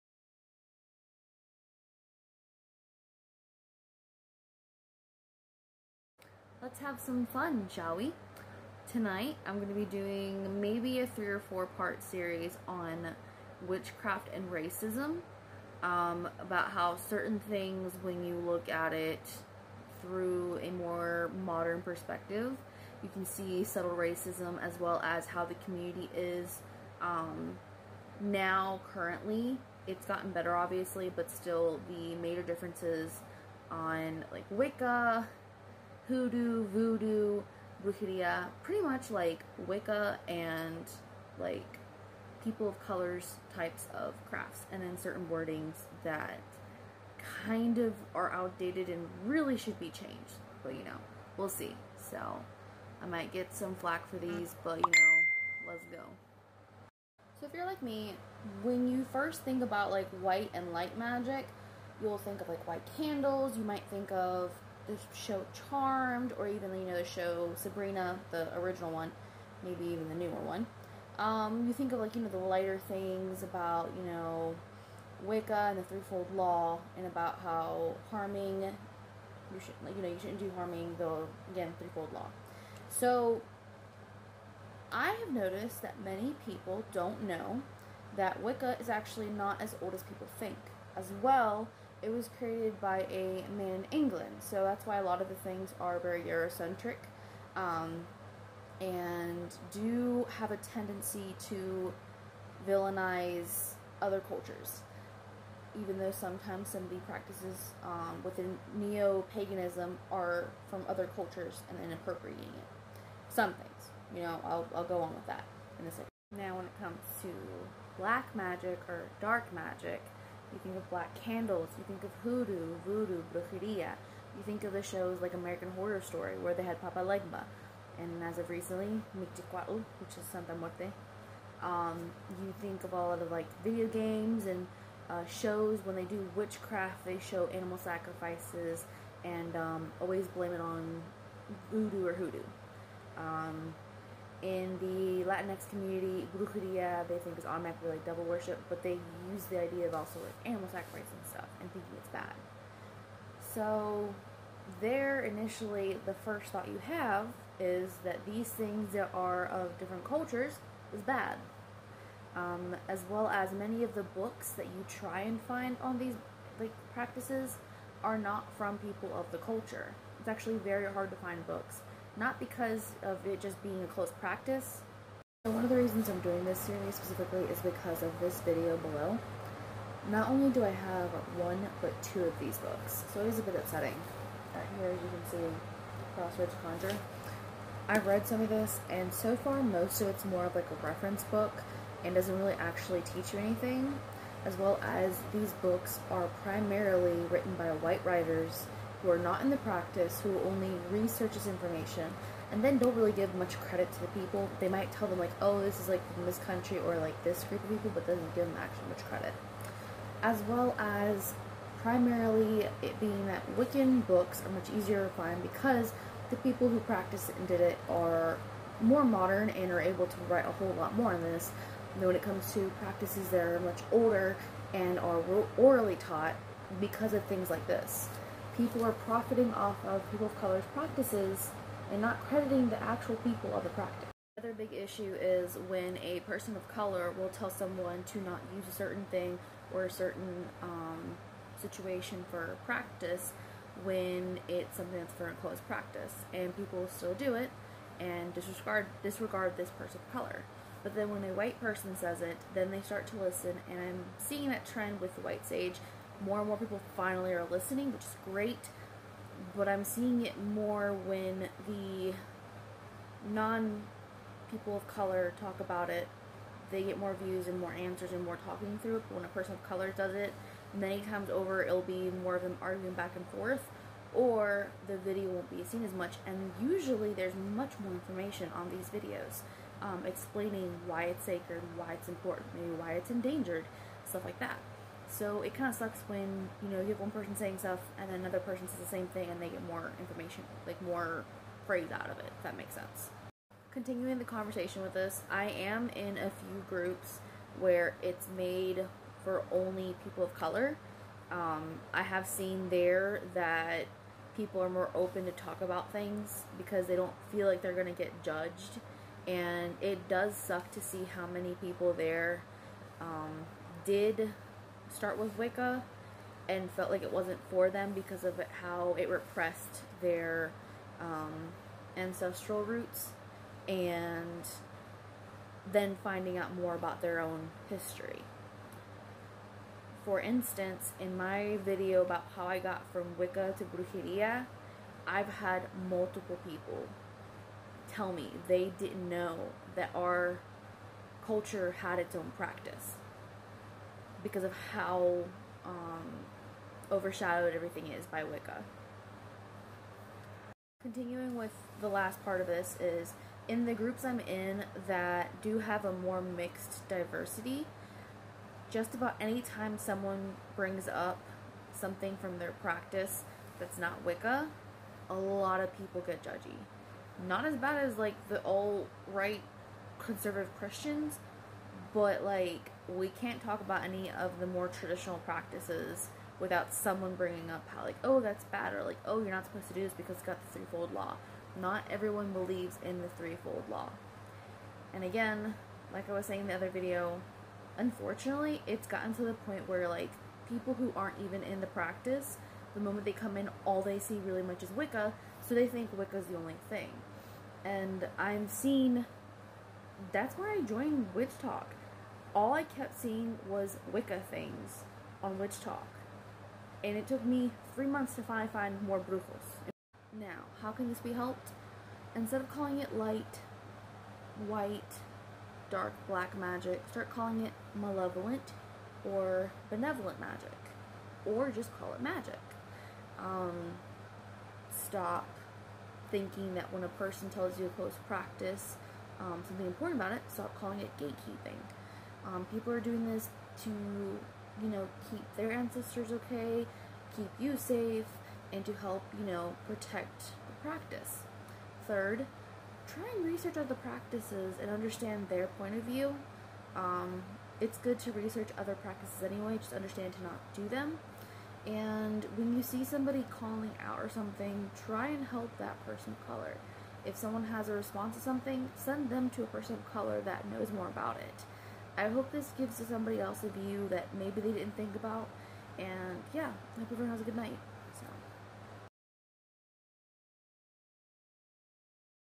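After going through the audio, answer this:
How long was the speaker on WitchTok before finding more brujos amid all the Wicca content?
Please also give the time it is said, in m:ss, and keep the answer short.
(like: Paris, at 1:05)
3 months, at 6:47.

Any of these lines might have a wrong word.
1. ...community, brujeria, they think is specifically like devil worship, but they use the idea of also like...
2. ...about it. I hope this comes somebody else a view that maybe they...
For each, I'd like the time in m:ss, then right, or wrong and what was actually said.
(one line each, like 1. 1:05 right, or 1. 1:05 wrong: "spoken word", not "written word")
1. 2:25 wrong: "automatically", not "specifically"
2. 7:40 wrong: "gives", not "comes".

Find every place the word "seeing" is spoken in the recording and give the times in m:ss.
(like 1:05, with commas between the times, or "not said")
4:14, 4:19, 6:38, 6:42.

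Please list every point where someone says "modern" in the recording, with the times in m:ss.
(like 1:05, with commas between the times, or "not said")
0:21, 3:39.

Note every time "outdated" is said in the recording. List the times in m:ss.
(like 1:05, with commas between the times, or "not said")
0:48.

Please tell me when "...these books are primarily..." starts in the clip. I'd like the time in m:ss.
3:15.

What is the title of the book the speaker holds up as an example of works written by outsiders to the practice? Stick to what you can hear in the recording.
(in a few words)
Crossroads Conjure.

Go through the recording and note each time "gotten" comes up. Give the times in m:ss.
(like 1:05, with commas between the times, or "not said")
0:30, 6:28.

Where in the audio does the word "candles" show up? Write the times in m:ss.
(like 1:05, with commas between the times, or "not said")
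1:02, 2:01.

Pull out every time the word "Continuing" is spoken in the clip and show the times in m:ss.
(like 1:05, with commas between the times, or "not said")
4:53, 5:50.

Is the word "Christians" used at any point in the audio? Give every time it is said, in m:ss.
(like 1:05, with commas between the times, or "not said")
6:10.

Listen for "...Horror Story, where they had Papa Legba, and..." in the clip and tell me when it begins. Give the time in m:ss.
2:05.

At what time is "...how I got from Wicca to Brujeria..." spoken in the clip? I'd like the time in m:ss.
5:32.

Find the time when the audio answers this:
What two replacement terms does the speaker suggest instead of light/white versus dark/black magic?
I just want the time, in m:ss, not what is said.
6:57.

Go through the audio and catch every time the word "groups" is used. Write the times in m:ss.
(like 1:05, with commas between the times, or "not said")
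3:27, 4:56, 5:53.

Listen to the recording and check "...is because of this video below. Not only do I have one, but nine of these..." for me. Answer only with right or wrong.
wrong.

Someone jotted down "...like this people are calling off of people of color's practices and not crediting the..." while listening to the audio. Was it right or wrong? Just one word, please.
wrong.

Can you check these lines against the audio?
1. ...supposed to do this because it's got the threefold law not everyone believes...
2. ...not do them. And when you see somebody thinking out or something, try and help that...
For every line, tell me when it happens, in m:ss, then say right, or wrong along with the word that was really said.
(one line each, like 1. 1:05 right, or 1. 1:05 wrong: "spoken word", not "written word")
1. 6:19 right
2. 7:30 wrong: "calling", not "thinking".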